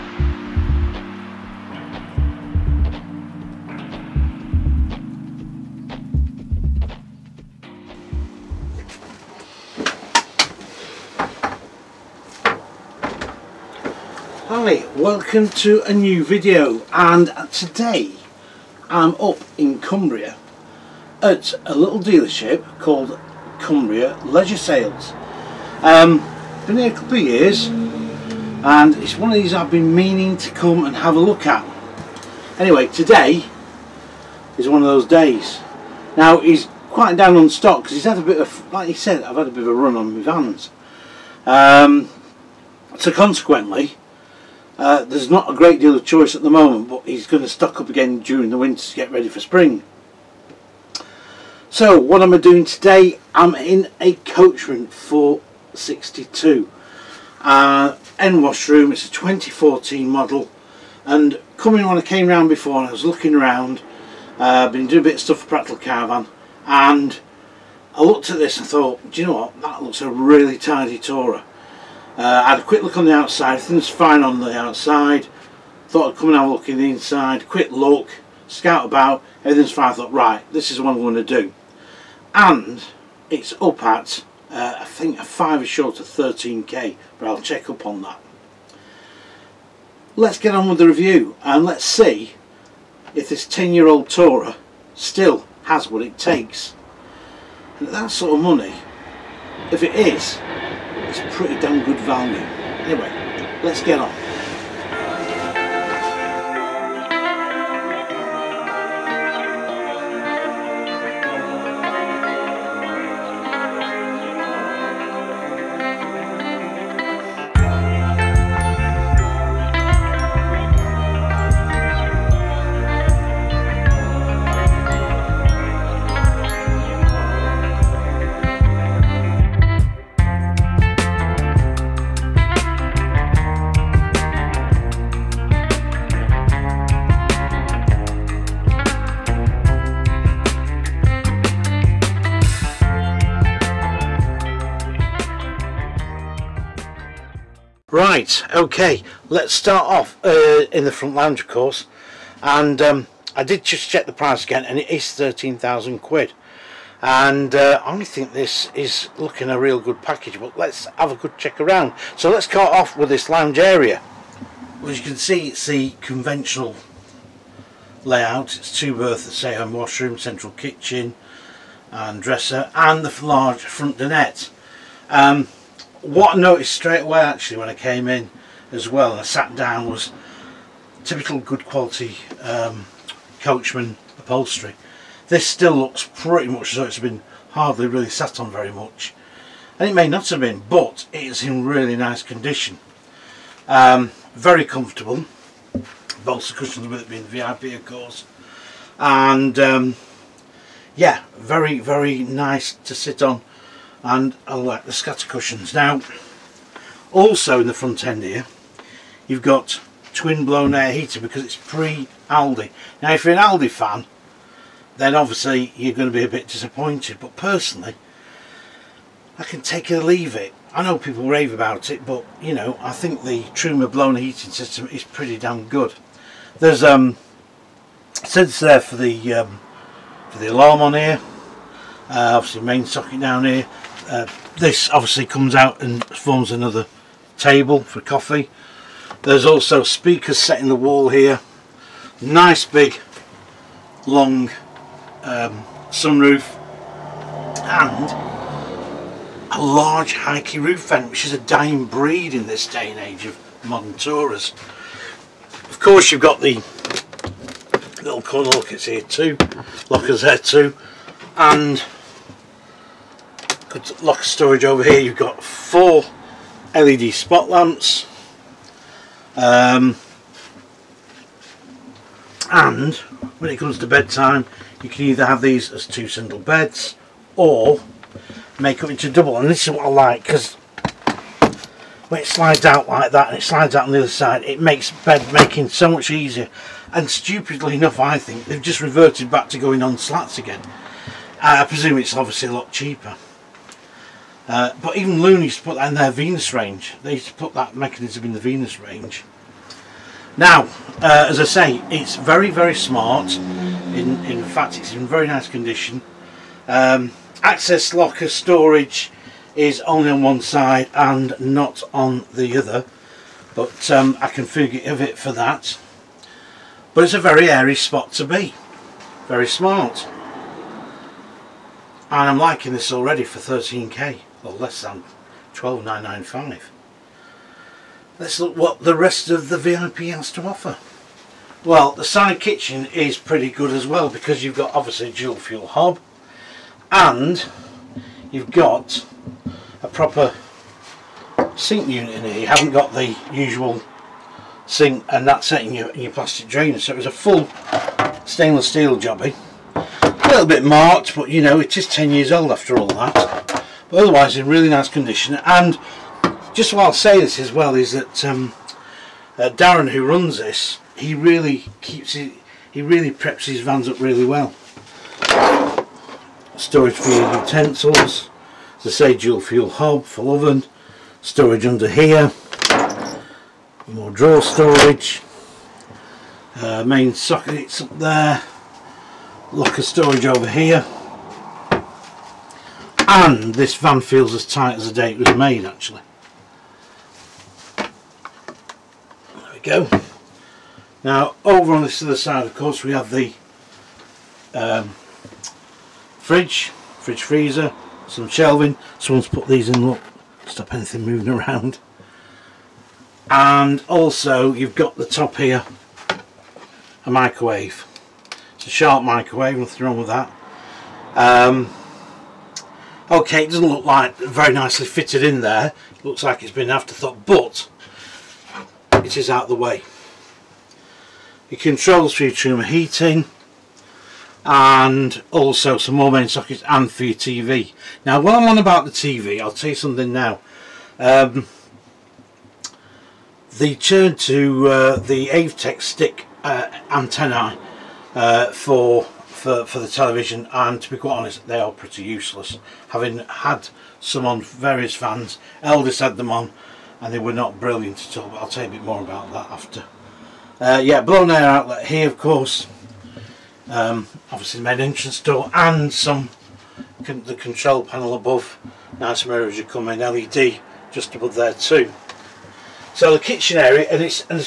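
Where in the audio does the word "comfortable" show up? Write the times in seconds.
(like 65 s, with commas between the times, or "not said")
194 s.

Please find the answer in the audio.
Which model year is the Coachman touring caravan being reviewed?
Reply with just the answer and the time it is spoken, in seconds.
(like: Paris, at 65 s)
2014, at 59 s.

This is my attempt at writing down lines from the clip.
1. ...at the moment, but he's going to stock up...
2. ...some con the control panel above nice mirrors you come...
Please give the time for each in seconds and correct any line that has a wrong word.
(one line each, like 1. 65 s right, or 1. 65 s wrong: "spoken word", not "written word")
1. 46 s right
2. 455 s right.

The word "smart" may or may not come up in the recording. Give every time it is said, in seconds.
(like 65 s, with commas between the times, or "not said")
302 s, 319 s.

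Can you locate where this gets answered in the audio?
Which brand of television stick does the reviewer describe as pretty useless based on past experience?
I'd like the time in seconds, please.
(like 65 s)
435 s.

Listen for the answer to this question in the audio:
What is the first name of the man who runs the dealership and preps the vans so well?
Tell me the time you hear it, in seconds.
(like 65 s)
359 s.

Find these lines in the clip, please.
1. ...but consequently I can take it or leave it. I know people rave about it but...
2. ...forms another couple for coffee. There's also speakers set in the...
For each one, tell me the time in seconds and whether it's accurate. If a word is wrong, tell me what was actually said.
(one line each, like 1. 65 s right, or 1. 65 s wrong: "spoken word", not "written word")
1. 217 s wrong: "personally", not "consequently"
2. 236 s wrong: "table", not "couple".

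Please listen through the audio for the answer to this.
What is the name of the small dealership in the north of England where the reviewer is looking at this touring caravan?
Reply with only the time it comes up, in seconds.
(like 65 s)
23 s.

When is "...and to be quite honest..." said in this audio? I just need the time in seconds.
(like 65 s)
440 s.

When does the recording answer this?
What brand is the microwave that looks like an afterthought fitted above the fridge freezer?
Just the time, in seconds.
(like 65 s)
408 s.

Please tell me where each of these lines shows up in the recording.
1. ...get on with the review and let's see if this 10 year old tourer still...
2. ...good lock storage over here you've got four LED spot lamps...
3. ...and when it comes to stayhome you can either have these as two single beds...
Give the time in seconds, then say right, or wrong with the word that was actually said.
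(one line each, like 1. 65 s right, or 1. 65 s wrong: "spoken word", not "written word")
1. 90 s right
2. 263 s right
3. 272 s wrong: "bedtime", not "stayhome".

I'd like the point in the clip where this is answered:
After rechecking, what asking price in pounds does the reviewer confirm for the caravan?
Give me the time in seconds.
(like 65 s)
155 s.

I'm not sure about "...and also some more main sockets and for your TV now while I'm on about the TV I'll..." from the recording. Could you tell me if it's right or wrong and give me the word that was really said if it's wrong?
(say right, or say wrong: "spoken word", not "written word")
right.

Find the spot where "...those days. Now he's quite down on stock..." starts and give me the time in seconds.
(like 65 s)
34 s.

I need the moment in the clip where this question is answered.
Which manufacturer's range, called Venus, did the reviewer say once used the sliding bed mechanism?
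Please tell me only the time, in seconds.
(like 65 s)
295 s.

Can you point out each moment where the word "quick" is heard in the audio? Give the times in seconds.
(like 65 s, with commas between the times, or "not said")
72 s, 77 s.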